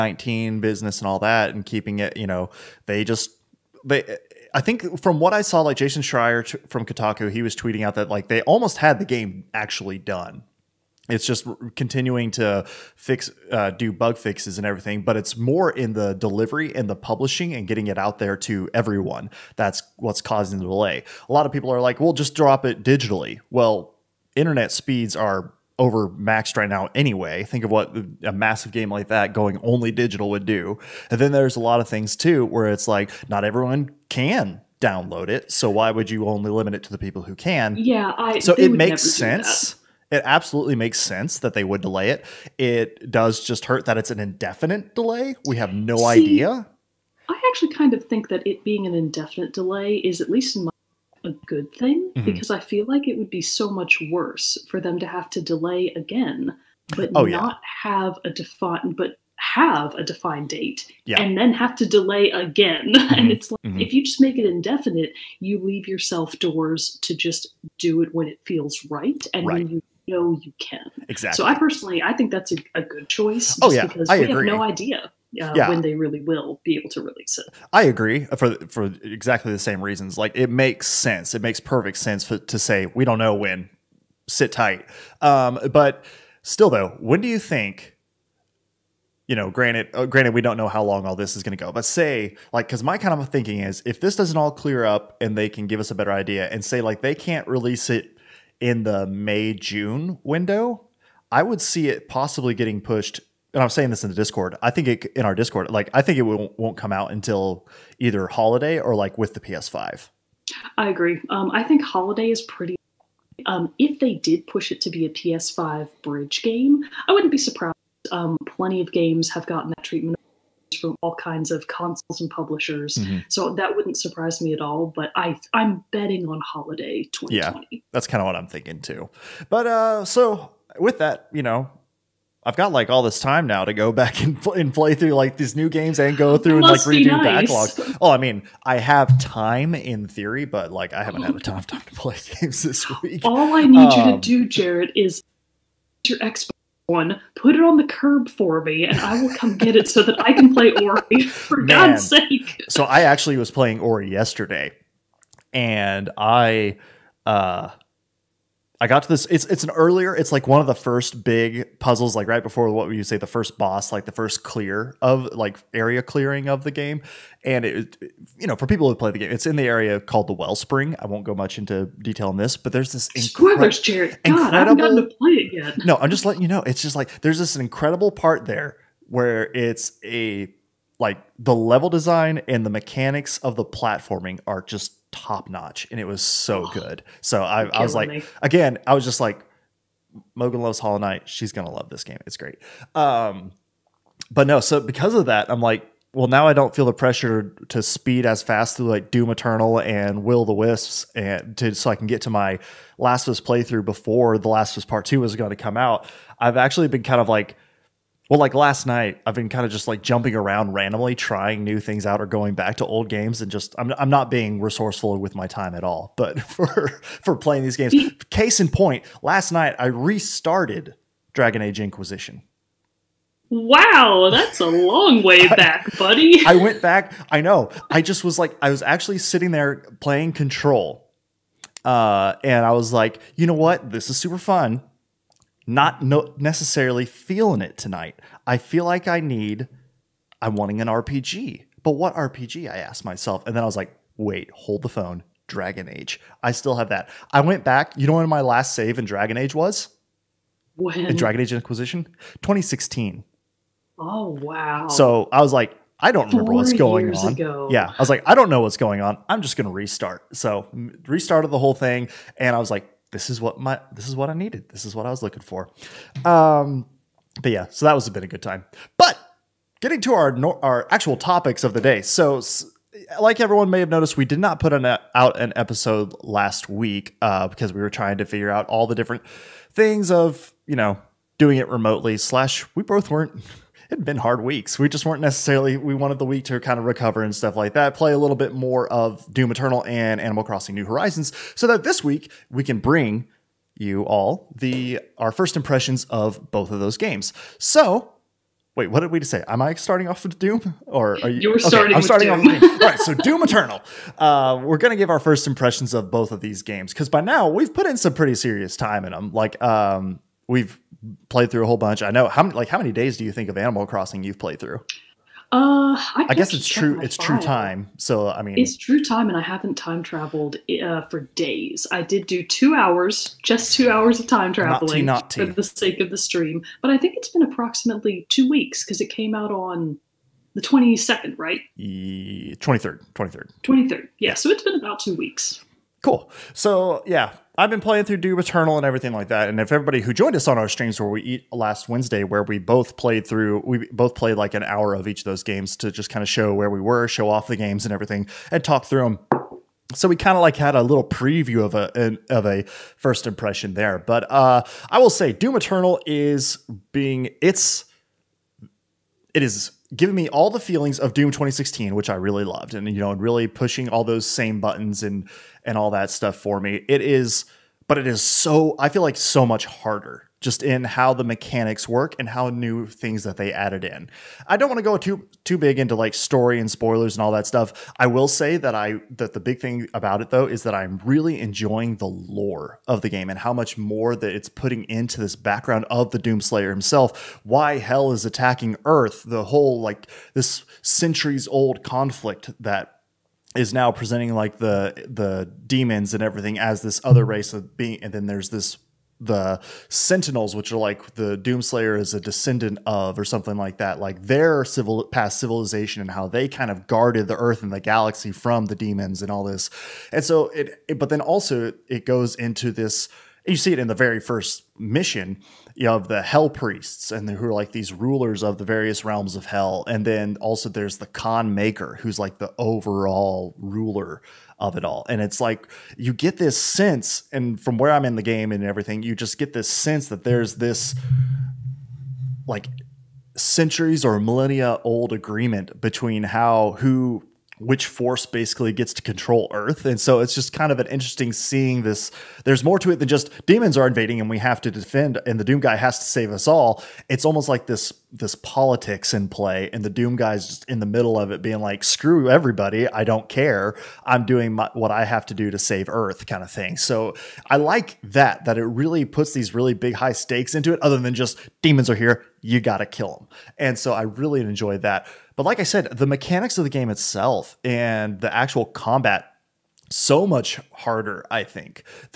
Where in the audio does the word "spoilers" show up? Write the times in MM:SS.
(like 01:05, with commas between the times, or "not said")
02:53, 06:16.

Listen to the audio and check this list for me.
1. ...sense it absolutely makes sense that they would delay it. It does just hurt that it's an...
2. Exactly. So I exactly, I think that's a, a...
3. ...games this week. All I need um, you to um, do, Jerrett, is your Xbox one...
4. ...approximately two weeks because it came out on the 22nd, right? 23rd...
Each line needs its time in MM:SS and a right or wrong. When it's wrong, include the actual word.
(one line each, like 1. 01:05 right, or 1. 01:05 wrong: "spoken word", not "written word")
1. 00:39 right
2. 01:11 wrong: "personally", not "exactly"
3. 02:22 right
4. 05:27 right.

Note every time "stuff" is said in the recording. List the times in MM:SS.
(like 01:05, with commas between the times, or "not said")
04:47, 06:06, 06:17.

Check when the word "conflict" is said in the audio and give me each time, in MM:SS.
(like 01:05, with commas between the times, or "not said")
06:31.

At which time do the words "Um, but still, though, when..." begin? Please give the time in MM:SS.
01:25.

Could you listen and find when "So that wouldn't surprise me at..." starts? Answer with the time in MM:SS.
02:03.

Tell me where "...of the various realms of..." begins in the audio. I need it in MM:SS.
06:58.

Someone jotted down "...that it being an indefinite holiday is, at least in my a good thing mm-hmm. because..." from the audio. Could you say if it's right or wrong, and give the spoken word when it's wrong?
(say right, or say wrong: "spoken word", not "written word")
wrong: "delay", not "holiday".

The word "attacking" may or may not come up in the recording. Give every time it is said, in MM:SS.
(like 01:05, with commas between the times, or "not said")
06:28.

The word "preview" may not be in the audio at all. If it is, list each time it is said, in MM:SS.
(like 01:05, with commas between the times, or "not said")
05:51.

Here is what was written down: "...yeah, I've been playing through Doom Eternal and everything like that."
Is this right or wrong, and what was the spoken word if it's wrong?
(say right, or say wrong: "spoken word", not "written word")
right.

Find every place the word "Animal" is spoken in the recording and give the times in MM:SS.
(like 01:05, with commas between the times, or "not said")
04:50, 05:13.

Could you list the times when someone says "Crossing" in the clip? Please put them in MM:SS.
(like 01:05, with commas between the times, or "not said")
04:50, 05:13.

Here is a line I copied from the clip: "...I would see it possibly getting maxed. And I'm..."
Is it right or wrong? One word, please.
wrong.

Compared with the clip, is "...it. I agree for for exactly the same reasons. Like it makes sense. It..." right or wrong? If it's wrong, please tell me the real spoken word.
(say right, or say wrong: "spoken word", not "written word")
right.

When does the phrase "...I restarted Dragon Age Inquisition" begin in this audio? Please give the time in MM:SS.
03:39.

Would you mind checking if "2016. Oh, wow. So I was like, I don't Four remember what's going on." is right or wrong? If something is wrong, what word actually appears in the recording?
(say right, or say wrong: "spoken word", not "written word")
right.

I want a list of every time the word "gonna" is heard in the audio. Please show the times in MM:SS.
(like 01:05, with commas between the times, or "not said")
03:11, 05:04.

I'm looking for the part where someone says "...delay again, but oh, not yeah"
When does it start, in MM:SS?
00:55.